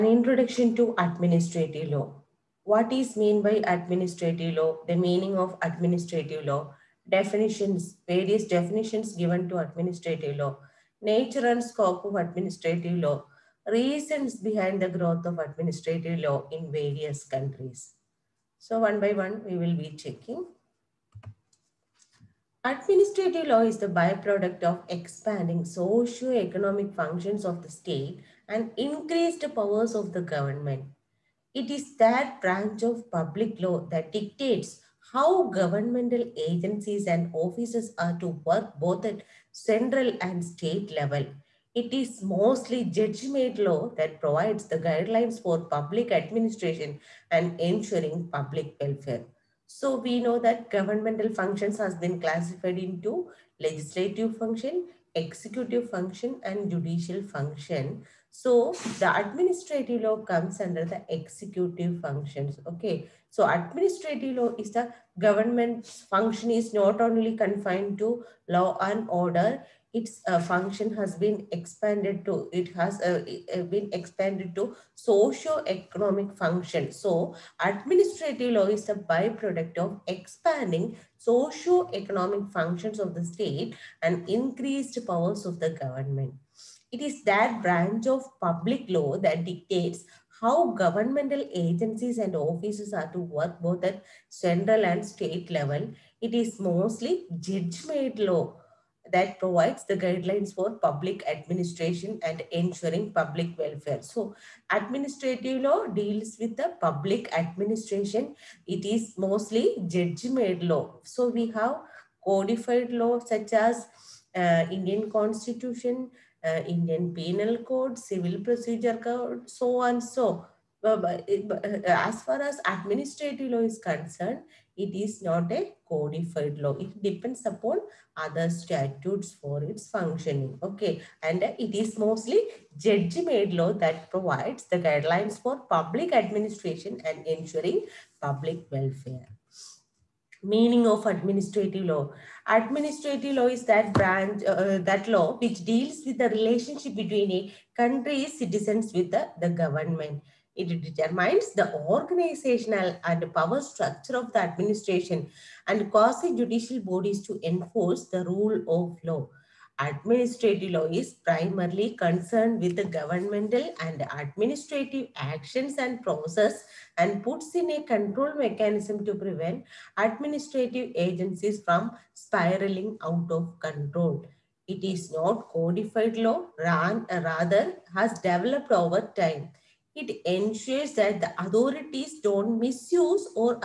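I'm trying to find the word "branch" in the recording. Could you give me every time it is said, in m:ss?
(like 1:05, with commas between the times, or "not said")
0:32, 1:27, 2:23.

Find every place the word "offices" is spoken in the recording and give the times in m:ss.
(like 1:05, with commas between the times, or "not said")
0:37, 1:32.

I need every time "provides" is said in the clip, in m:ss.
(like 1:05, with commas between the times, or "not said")
0:44, 1:39, 2:14.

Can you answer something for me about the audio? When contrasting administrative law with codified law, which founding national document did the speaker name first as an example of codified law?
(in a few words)
Indian Constitution.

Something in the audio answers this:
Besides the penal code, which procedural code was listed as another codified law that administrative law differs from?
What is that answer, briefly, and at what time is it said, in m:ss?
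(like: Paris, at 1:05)
Civil Procedure Code, at 1:57.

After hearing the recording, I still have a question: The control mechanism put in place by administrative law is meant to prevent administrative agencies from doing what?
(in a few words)
spiraling out of control.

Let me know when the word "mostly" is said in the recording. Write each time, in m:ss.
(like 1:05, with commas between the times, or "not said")
0:42, 1:36, 1:49, 2:11.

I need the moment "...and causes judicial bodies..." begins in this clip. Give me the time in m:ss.
2:35.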